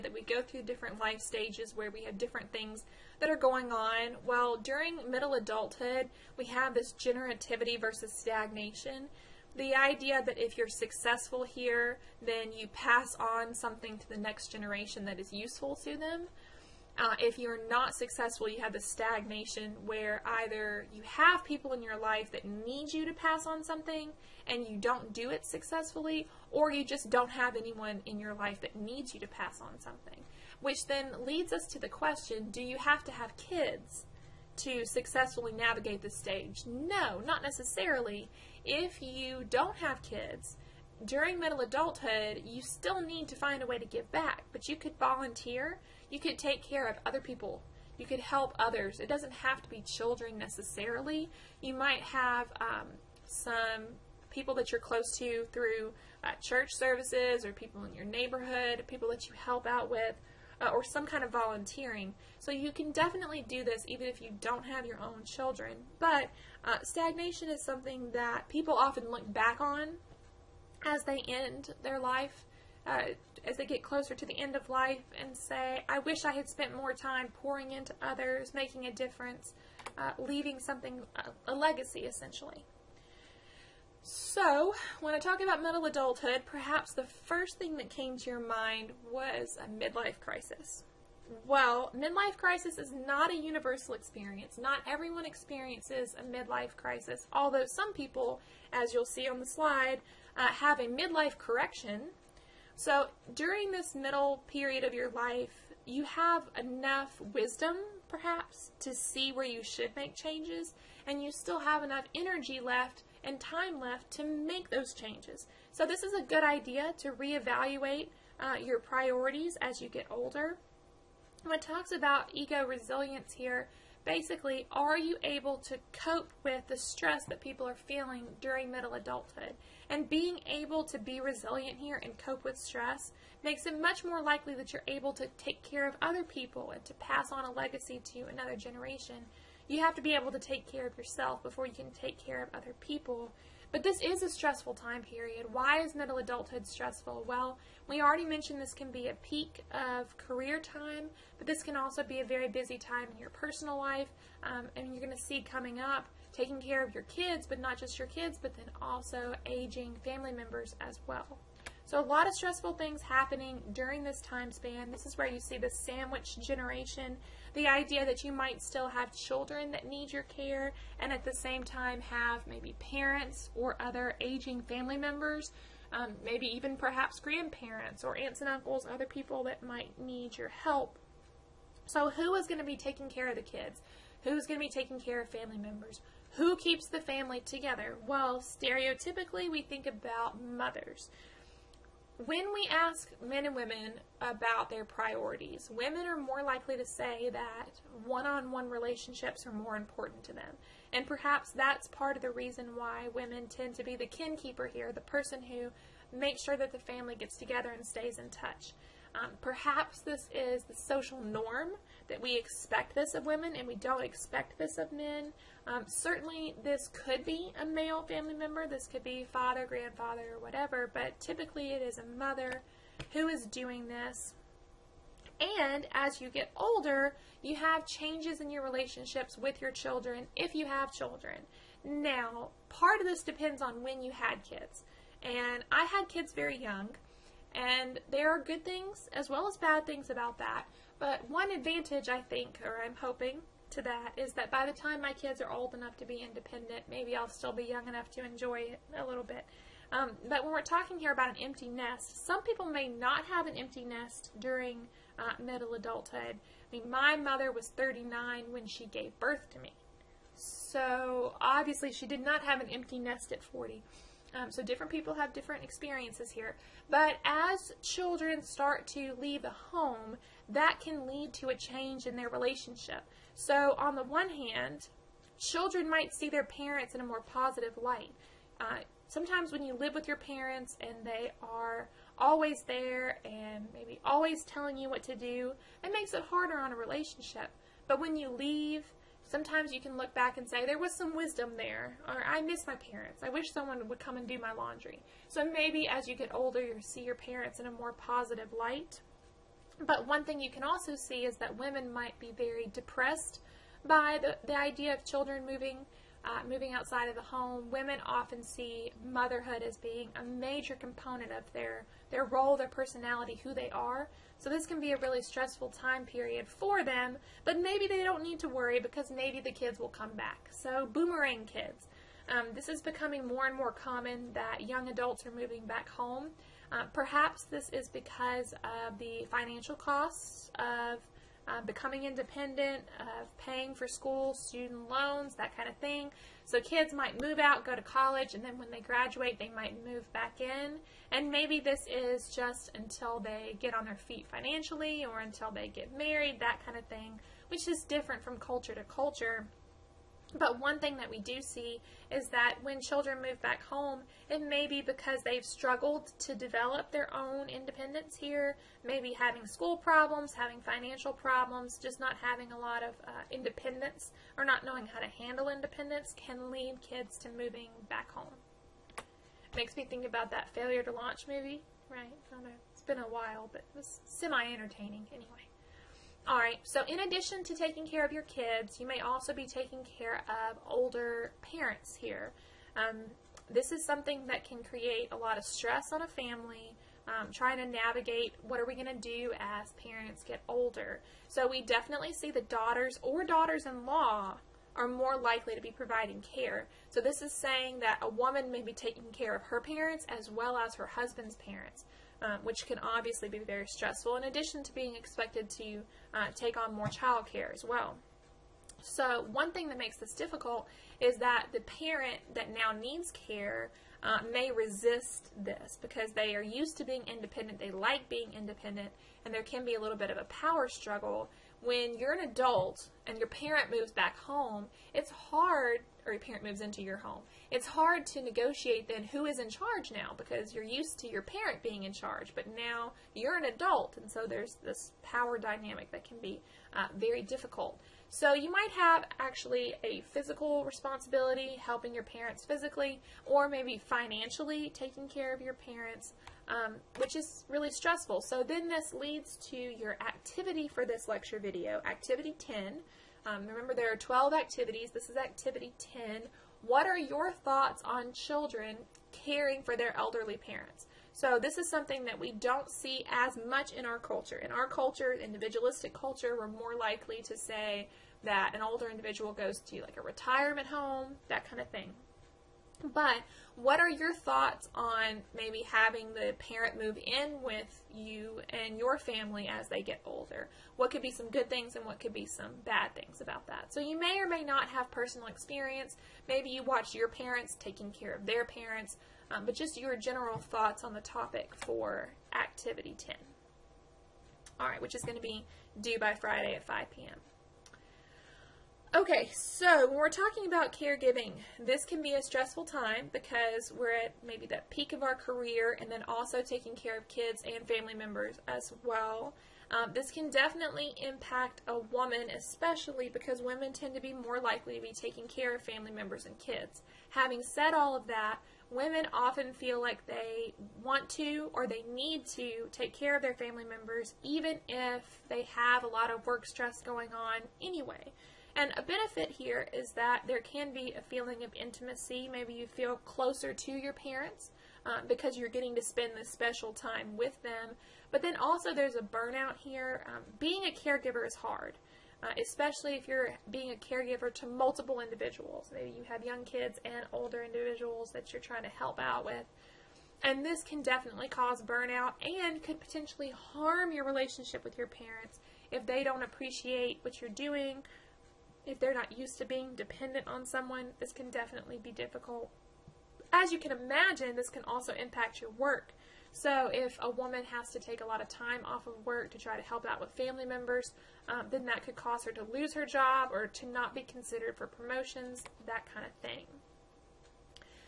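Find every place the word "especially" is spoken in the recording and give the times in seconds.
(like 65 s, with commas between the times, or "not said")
512 s, 542 s.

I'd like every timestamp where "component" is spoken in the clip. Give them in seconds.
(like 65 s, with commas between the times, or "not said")
310 s.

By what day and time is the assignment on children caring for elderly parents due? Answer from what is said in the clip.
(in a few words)
Friday at 5 p.m.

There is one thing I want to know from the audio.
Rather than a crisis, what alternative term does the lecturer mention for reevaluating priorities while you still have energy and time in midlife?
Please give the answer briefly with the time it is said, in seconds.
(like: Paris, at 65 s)
Midlife correction, at 100 s.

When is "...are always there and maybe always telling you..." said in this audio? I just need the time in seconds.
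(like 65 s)
281 s.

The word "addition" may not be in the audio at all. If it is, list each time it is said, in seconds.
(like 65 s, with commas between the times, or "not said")
376 s, 404 s.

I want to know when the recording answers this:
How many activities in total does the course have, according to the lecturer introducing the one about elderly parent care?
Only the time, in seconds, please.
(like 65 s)
453 s.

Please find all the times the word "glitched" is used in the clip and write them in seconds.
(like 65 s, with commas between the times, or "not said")
not said.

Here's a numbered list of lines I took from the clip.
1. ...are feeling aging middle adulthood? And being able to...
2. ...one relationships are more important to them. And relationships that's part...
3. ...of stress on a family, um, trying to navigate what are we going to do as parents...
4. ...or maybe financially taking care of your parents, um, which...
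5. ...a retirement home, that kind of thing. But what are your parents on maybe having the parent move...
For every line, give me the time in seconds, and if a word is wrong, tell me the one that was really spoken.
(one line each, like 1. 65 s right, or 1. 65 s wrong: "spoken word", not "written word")
1. 127 s wrong: "during", not "aging"
2. 198 s wrong: "perhaps", not "relationships"
3. 385 s right
4. 443 s right
5. 469 s wrong: "thoughts", not "parents".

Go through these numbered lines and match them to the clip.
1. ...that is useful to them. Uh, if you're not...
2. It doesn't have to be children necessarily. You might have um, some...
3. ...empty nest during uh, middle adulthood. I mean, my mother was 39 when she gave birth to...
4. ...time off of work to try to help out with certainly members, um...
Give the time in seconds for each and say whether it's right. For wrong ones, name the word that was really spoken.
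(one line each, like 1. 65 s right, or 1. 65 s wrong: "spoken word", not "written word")
1. 15 s right
2. 48 s right
3. 253 s right
4. 568 s wrong: "family", not "certainly".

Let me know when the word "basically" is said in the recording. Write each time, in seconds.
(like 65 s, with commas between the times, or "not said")
124 s.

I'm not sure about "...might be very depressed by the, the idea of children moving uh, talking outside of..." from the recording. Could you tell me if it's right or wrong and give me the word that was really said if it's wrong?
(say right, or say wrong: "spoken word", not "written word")
wrong: "moving", not "talking".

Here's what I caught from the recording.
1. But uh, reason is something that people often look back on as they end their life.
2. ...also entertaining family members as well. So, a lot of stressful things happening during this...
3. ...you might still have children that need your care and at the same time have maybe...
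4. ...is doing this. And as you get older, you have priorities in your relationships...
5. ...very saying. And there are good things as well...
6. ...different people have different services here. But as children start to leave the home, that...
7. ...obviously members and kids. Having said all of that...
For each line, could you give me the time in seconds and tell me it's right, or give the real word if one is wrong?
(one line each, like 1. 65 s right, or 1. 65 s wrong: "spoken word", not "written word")
1. 65 s wrong: "stagnation", not "reason"
2. 158 s wrong: "aging", not "entertaining"
3. 168 s right
4. 223 s wrong: "changes", not "priorities"
5. 236 s wrong: "young", not "saying"
6. 264 s wrong: "experiences", not "services"
7. 515 s wrong: "family", not "obviously".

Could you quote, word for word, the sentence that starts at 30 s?
Which then leads us to the question do you have to have kids to successfully navigate this stage?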